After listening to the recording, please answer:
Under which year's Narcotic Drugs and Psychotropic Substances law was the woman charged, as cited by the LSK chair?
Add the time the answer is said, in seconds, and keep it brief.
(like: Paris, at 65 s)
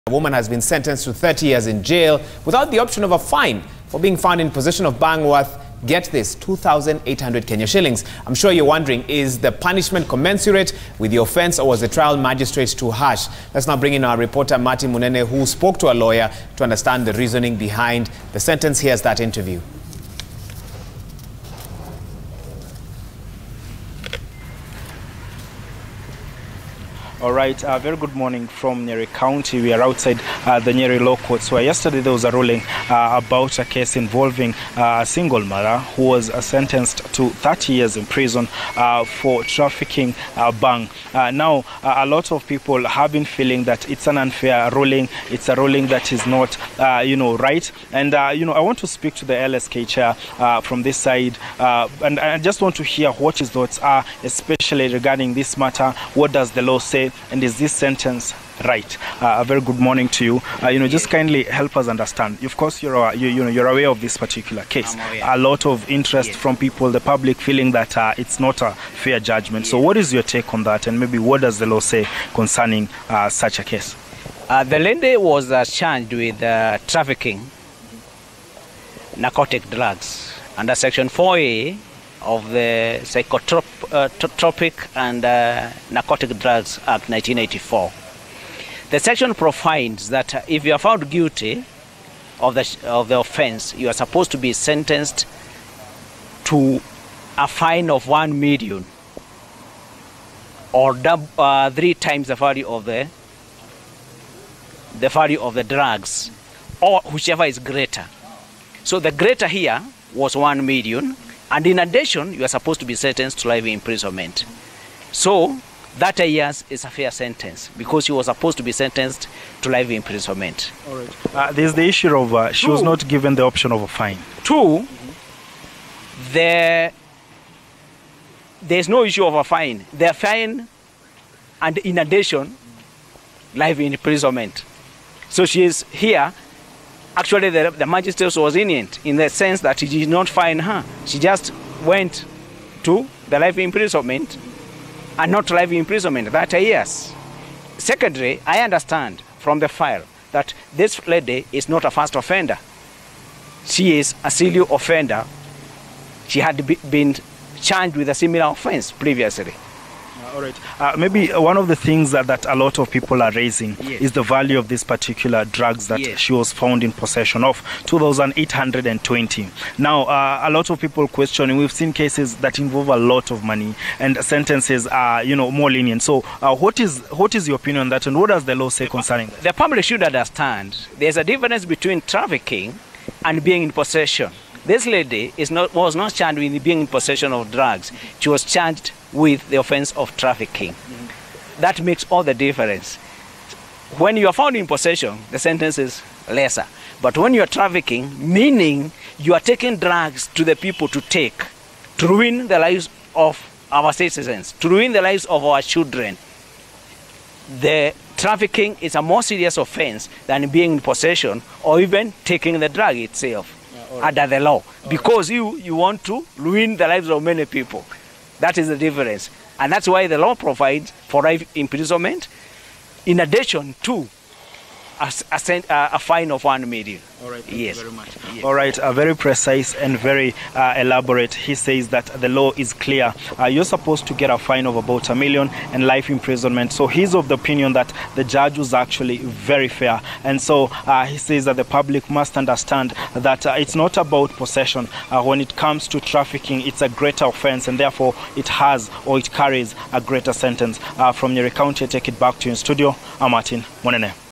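1984, at 87 s.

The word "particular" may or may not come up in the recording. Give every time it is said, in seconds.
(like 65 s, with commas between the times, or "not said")
64 s, 164 s.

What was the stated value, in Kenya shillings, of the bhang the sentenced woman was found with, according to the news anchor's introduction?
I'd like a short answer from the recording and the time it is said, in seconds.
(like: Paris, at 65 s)
2,800, at 6 s.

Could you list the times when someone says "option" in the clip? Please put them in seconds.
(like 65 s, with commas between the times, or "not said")
2 s, 123 s.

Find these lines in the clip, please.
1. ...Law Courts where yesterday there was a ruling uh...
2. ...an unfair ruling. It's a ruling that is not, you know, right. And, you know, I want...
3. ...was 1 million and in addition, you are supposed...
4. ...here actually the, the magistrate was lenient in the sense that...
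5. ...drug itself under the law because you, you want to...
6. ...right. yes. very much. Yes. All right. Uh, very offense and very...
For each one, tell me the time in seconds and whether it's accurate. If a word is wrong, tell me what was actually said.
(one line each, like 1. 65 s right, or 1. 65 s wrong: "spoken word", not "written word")
1. 30 s right
2. 44 s right
3. 110 s right
4. 135 s right
5. 212 s right
6. 227 s wrong: "precise", not "offense".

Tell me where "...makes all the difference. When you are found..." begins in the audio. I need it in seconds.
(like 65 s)
191 s.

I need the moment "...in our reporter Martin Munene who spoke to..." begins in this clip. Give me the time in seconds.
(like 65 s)
13 s.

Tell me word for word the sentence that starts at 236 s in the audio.
So he's of the opinion that the judge was actually very fair.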